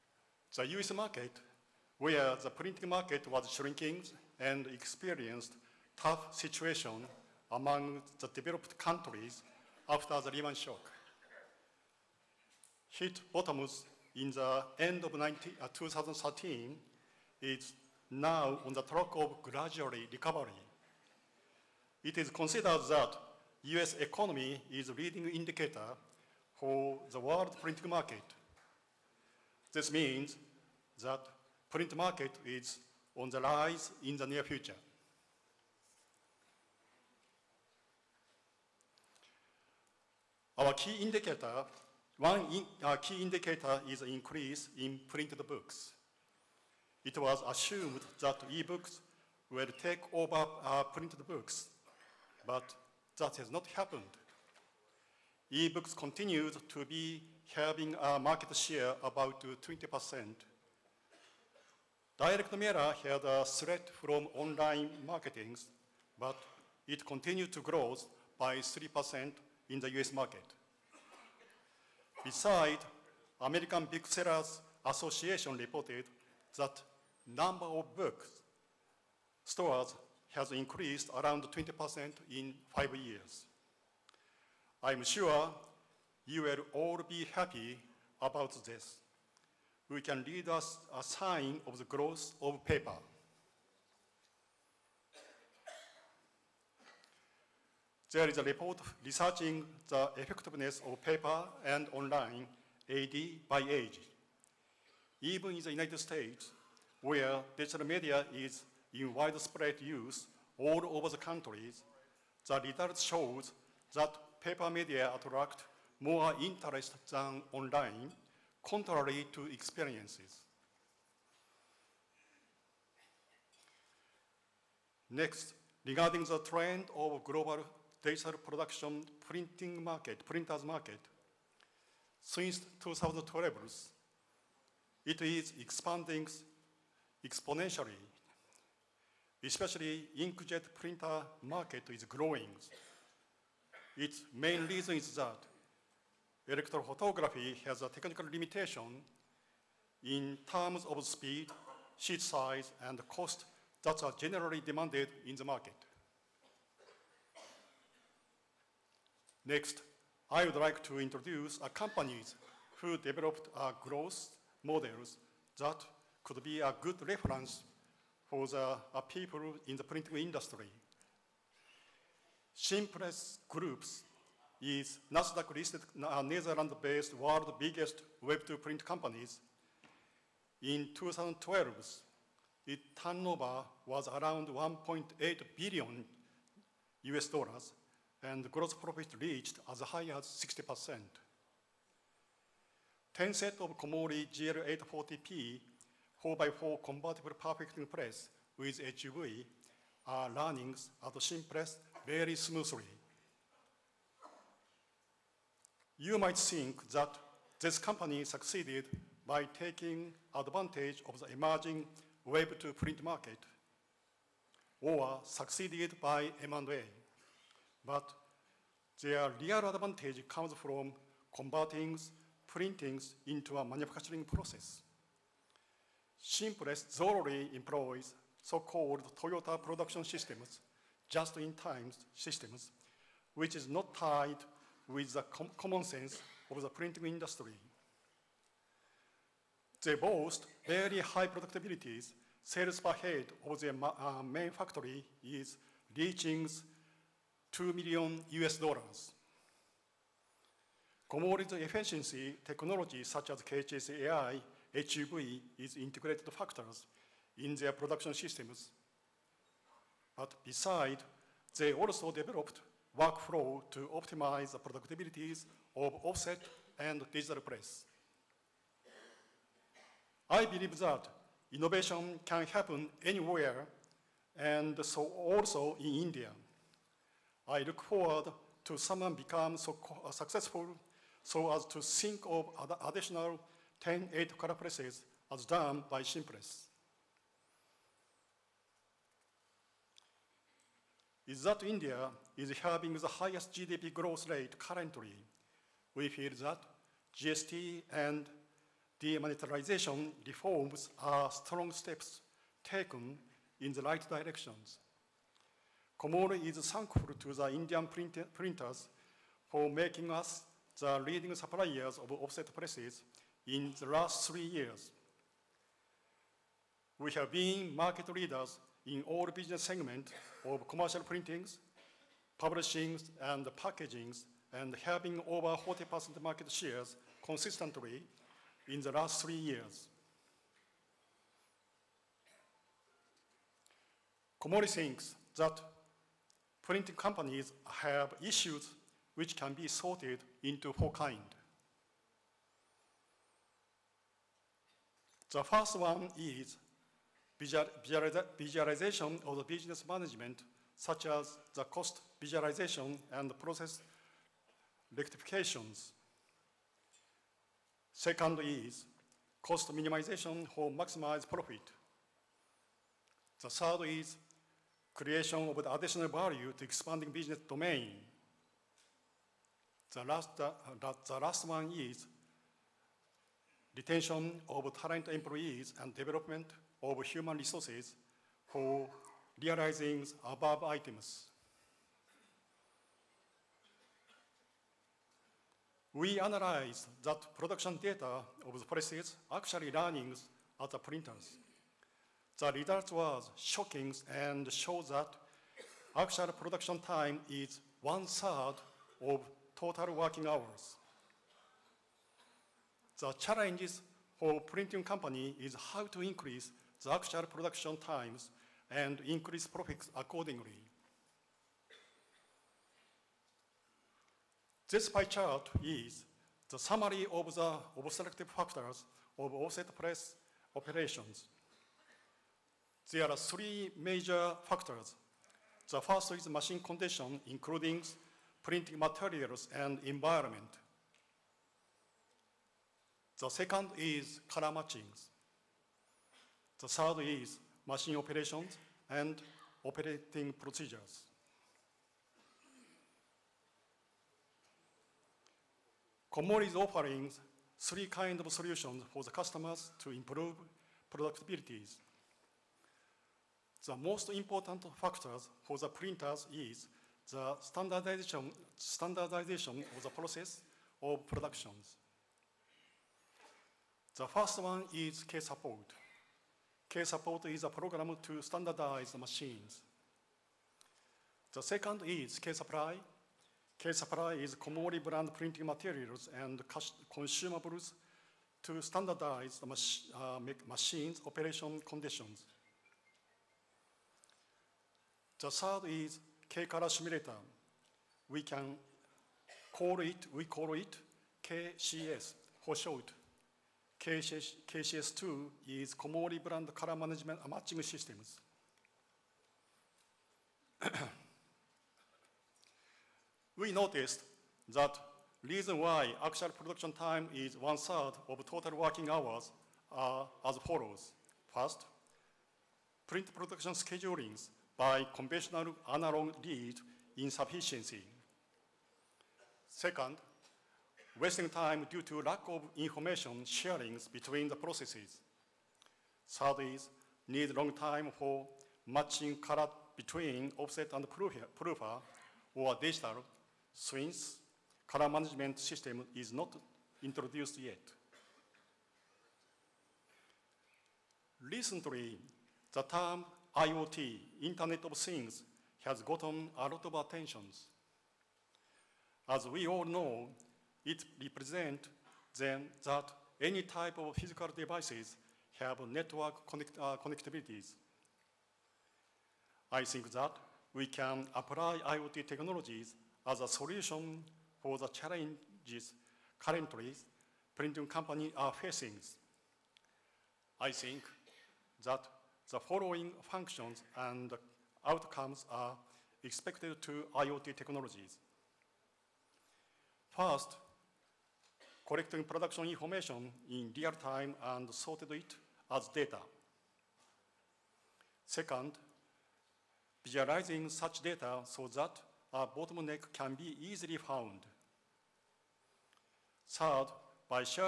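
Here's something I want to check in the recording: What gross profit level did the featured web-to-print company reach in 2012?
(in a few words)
60%.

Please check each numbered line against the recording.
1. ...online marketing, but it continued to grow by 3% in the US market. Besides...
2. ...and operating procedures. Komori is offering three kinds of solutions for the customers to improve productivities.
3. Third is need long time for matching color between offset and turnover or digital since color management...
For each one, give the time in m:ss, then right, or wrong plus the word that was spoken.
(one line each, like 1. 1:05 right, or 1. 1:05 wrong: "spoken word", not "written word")
1. 1:04 right
2. 7:18 right
3. 8:46 wrong: "proofer", not "turnover".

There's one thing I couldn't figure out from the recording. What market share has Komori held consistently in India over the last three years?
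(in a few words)
over 40%.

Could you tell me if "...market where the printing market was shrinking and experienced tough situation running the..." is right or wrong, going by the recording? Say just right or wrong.
wrong.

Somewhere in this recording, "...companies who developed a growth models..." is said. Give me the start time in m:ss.
2:41.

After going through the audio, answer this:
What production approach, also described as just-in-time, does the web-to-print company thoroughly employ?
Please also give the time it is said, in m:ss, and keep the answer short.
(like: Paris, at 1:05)
Toyota production systems, at 3:49.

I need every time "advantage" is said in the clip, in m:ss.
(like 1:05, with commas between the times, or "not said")
3:30, 3:39.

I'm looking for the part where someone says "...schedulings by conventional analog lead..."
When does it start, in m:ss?
8:33.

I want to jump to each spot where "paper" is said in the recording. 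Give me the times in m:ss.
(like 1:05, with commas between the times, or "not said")
1:32, 1:41, 1:54.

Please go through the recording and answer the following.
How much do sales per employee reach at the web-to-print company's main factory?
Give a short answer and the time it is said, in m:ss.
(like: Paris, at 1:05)
2 million US dollars, at 4:07.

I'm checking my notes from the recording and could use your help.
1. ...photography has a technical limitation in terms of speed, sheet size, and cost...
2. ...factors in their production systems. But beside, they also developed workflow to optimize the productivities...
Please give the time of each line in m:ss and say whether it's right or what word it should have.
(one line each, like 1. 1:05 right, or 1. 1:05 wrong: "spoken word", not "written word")
1. 2:26 right
2. 4:16 right.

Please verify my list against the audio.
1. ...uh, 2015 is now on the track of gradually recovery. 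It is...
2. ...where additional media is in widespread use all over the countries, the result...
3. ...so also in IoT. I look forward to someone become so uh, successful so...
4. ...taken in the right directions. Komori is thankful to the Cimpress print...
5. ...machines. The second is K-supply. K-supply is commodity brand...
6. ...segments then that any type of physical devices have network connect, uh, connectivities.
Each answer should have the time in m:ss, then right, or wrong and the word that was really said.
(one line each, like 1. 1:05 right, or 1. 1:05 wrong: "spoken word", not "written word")
1. 0:15 wrong: "2013", not "2015"
2. 1:47 wrong: "digital", not "additional"
3. 4:34 wrong: "India", not "IoT"
4. 5:02 wrong: "Indian", not "Cimpress"
5. 7:48 right
6. 9:11 wrong: "represents", not "segments".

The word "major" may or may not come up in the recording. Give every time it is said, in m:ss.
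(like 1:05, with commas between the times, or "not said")
7:03.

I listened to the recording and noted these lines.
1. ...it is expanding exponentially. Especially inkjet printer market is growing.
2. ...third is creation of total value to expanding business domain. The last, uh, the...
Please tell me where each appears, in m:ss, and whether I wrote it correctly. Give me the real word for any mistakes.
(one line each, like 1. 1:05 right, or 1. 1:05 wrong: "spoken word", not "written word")
1. 2:15 right
2. 6:03 wrong: "additional", not "total".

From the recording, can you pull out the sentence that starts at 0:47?
It was assumed that e-books will take over uh, printed books, but that has not happened.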